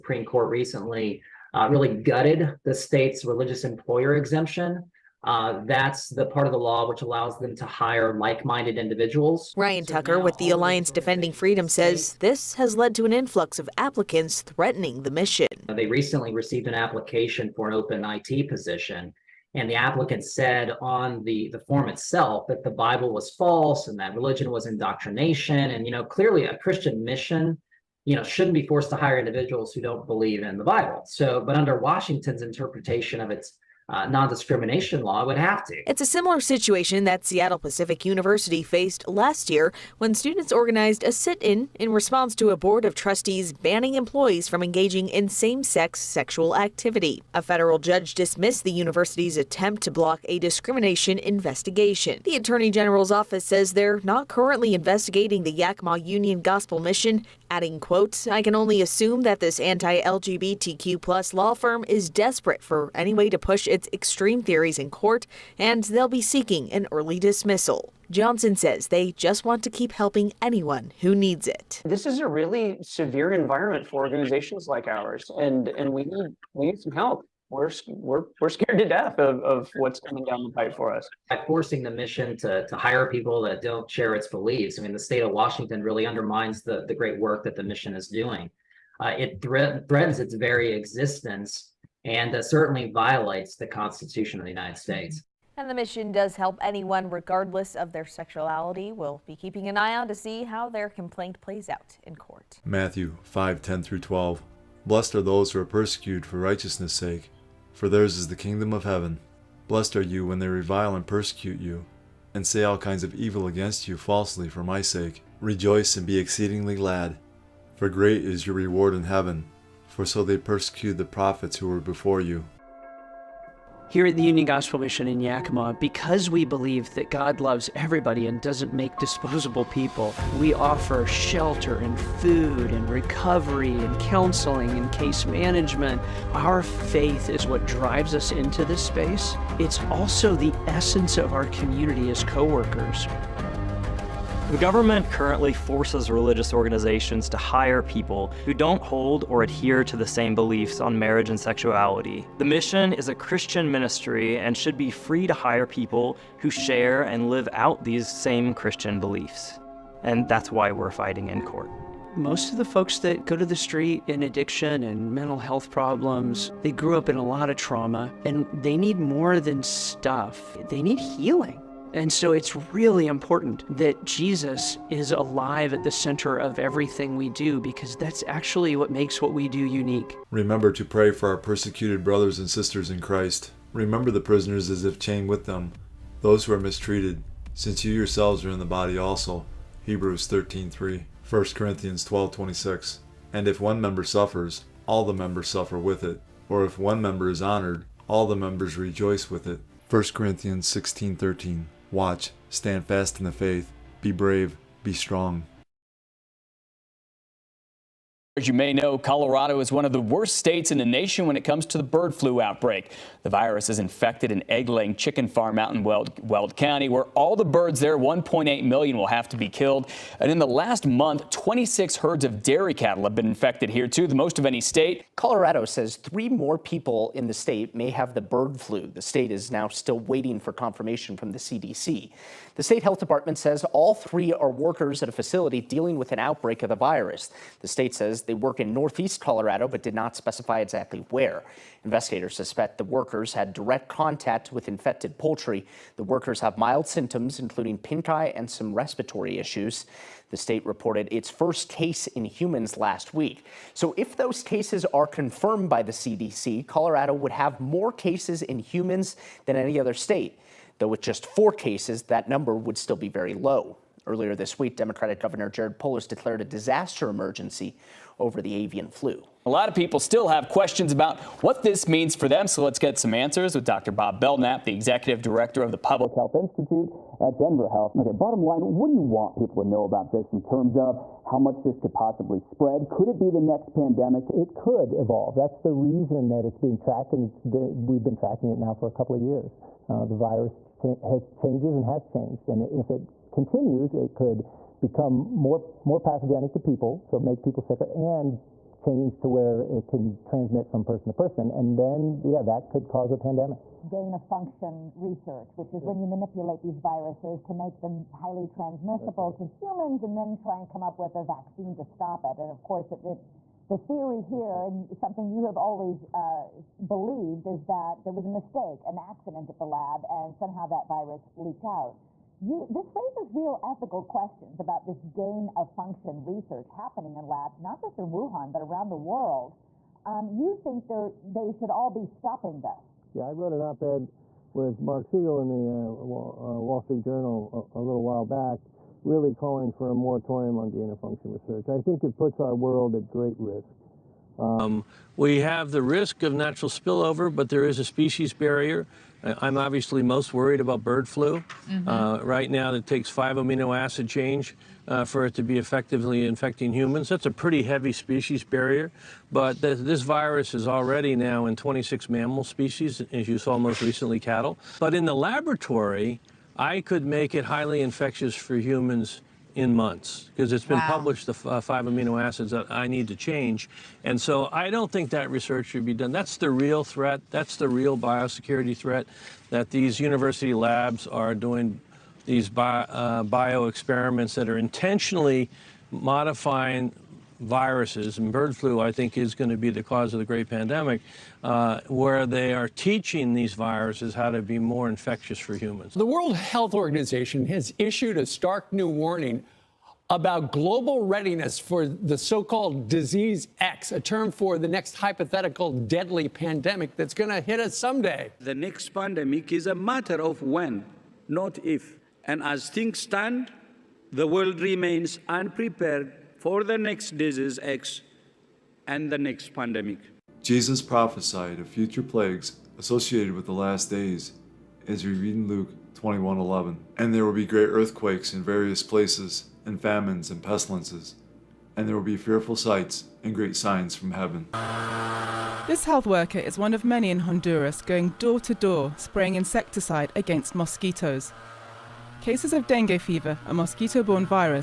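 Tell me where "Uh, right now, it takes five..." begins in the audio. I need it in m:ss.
5:51.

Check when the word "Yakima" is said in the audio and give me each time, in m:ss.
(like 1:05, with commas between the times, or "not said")
0:55, 2:05.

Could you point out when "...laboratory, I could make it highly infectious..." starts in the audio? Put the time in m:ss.
6:05.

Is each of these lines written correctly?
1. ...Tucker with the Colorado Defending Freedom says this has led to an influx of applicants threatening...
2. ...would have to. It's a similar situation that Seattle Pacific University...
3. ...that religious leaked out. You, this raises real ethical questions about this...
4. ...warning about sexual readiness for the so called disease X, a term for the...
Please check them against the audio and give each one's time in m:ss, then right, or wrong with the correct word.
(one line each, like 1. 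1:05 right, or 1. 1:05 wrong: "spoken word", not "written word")
1. 0:09 wrong: "Alliance", not "Colorado"
2. 0:35 right
3. 5:20 wrong: "virus", not "religious"
4. 6:38 wrong: "global", not "sexual".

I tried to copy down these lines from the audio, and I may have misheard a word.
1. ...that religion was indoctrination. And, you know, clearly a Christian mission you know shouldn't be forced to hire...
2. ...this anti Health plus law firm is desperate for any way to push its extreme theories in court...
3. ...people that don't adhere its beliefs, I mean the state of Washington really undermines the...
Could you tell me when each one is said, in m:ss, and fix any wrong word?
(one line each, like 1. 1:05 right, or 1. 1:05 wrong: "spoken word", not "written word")
1. 0:23 right
2. 0:59 wrong: "LGBTQ", not "Health"
3. 1:23 wrong: "share", not "adhere".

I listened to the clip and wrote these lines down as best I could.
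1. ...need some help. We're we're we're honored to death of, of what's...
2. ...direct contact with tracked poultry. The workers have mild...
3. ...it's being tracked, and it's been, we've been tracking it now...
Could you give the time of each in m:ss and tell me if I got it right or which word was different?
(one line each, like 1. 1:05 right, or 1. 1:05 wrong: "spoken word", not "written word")
1. 1:16 wrong: "scared", not "honored"
2. 4:03 wrong: "infected", not "tracked"
3. 4:46 right.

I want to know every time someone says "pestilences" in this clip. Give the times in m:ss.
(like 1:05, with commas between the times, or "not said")
7:10.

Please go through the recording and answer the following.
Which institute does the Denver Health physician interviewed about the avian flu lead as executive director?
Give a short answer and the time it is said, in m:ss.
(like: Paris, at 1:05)
Public Health Institute, at 4:35.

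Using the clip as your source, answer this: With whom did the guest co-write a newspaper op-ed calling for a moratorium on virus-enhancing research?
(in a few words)
Marc Siegel.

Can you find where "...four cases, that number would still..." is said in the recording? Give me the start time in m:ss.
4:21.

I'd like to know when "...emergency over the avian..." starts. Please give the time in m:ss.
4:27.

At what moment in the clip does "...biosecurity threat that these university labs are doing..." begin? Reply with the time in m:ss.
6:17.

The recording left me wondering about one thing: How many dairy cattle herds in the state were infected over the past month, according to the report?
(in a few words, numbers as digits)
26.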